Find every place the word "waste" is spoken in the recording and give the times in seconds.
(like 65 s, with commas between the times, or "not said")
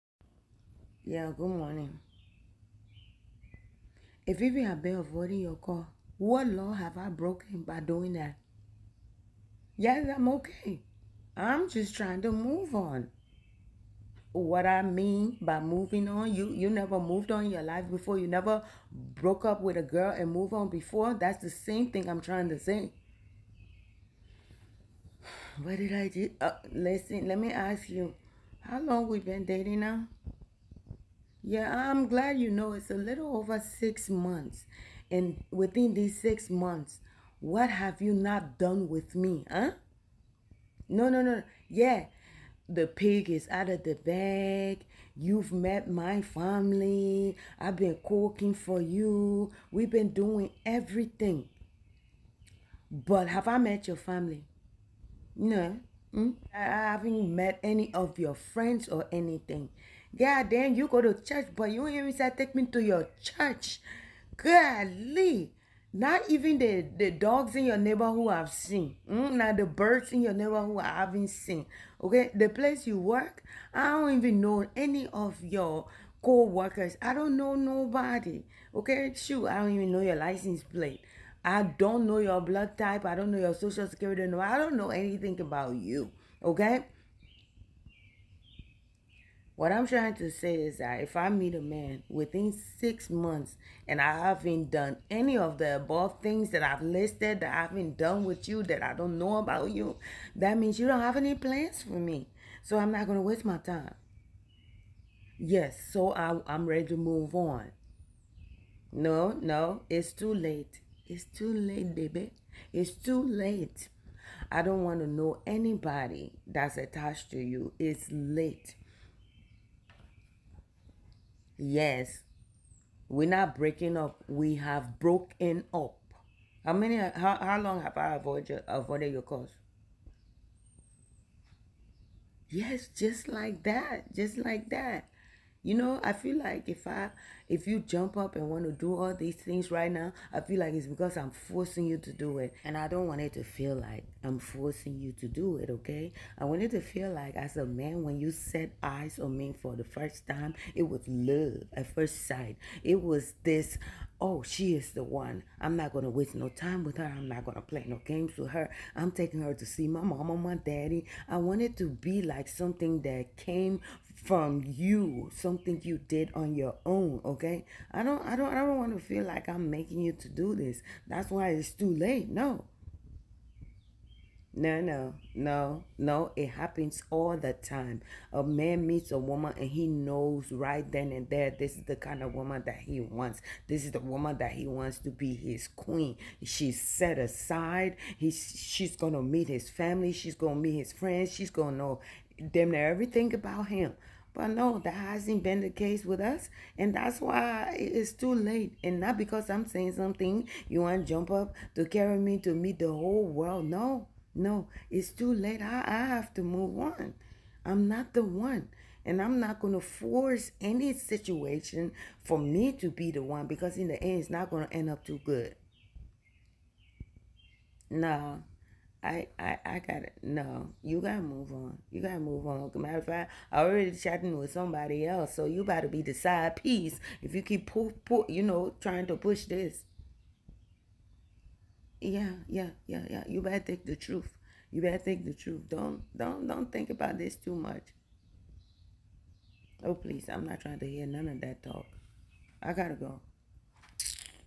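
103 s, 156 s.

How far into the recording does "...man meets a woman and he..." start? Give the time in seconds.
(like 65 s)
178 s.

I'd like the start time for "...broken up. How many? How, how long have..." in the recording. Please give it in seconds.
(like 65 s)
124 s.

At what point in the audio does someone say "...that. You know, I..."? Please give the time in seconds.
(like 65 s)
134 s.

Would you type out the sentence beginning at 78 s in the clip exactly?
Okay, shoot, I don't even know your license plate.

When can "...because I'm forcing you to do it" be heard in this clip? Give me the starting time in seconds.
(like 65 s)
140 s.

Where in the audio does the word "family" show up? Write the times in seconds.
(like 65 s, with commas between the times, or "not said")
46 s, 53 s, 189 s.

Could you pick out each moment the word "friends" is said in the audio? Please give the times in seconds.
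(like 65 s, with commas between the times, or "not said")
58 s, 190 s.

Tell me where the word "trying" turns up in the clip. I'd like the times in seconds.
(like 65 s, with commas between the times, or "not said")
11 s, 22 s, 89 s, 228 s, 240 s.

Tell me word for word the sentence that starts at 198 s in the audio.
And not because I'm saying something, you want to jump up to carry me to meet the whole world.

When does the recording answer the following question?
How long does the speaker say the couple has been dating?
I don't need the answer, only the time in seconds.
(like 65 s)
32 s.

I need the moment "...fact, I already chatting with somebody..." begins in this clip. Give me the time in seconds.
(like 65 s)
223 s.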